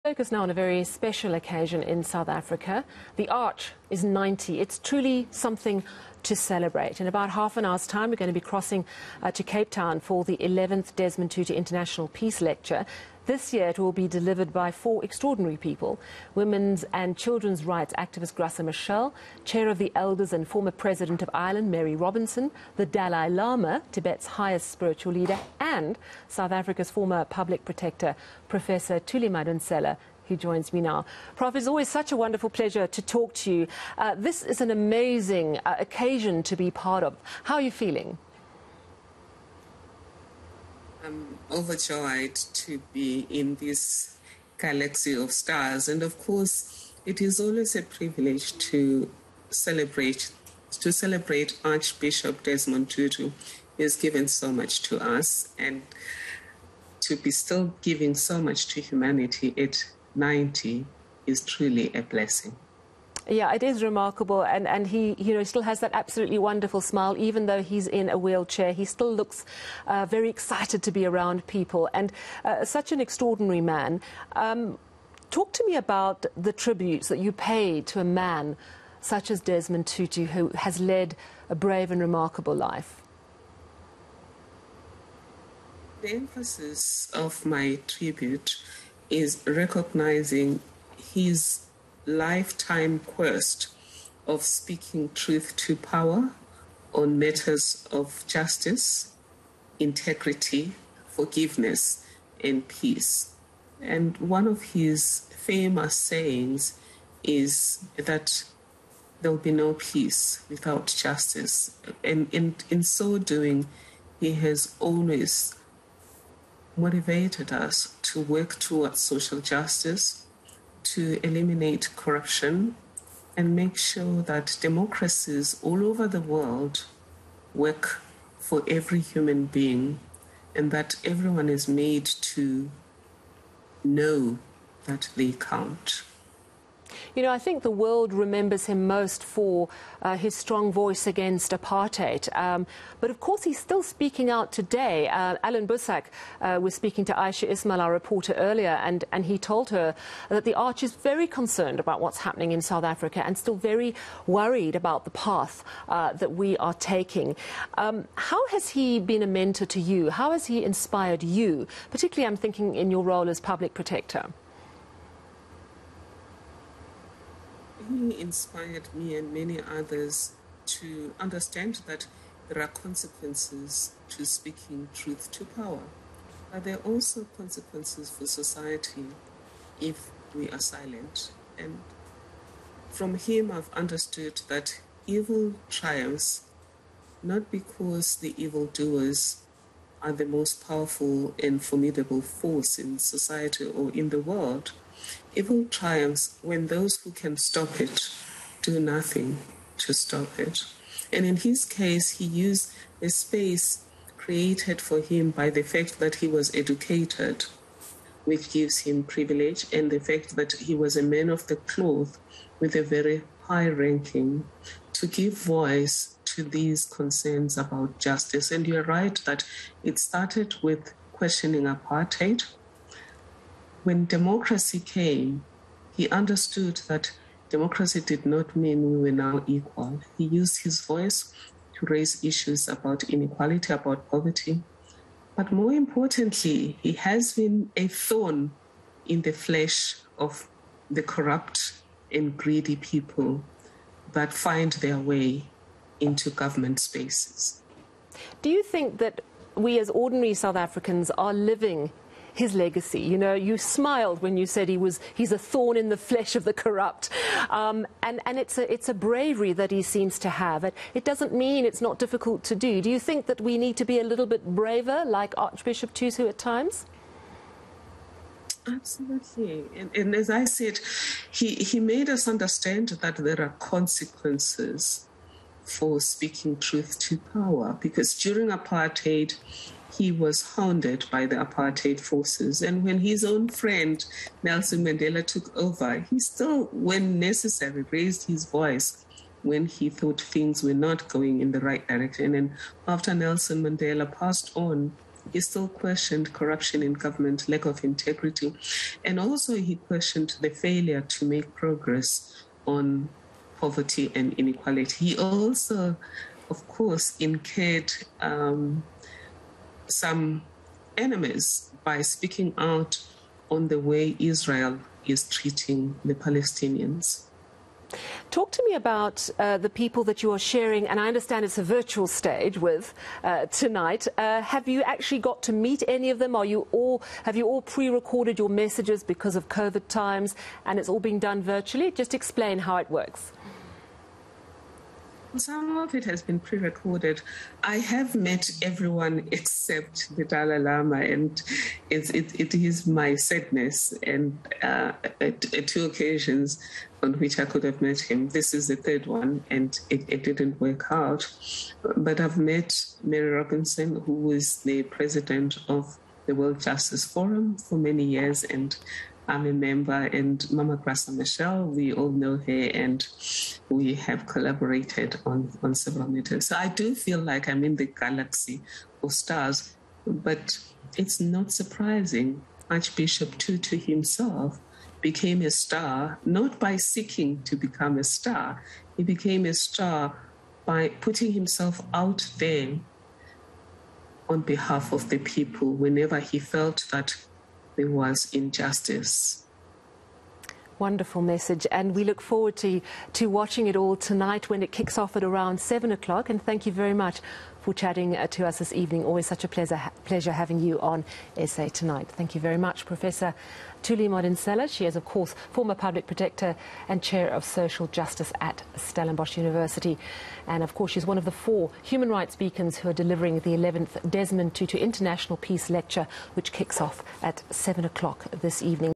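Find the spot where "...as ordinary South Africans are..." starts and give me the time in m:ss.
4:09.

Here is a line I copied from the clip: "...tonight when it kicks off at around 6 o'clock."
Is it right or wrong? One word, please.
wrong.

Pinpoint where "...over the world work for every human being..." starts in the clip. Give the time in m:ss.
2:05.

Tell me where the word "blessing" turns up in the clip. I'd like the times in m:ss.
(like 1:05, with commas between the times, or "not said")
1:02.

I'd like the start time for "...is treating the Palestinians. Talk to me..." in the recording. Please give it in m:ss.
5:15.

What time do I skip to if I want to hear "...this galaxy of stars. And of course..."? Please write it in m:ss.
0:43.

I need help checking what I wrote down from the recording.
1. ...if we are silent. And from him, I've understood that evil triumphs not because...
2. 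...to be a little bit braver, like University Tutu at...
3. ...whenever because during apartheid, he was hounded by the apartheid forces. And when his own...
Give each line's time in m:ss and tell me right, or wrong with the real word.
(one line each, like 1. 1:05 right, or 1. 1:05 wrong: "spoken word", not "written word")
1. 2:59 right
2. 4:23 wrong: "Archbishop", not "University"
3. 4:37 wrong: "power", not "whenever".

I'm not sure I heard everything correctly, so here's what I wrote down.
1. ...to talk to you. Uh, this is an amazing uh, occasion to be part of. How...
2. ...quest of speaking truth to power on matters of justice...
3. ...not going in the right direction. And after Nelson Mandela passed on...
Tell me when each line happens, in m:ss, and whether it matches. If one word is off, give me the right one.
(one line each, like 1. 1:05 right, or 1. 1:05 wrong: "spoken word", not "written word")
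1. 0:32 right
2. 1:32 right
3. 4:50 right.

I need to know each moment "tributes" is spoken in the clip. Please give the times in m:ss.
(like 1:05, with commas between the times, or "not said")
1:16, 1:27.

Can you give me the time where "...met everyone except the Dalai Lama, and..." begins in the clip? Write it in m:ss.
5:38.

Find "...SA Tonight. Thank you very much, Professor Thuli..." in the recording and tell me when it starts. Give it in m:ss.
6:41.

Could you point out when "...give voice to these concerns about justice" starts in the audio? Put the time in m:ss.
3:35.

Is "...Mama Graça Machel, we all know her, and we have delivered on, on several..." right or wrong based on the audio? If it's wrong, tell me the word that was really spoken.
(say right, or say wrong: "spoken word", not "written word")
wrong: "collaborated", not "delivered".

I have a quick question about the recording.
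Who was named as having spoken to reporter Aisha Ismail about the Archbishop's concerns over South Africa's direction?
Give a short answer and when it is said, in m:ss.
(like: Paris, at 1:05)
Allan Boesak, at 2:25.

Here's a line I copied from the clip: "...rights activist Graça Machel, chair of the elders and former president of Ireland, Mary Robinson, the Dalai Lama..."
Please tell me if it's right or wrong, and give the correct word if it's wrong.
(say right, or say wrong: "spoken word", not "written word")
right.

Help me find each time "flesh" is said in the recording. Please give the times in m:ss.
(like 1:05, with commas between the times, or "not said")
3:59, 4:15.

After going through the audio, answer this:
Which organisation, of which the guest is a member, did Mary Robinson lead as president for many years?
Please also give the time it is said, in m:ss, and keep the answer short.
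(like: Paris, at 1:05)
World Justice Forum, at 5:56.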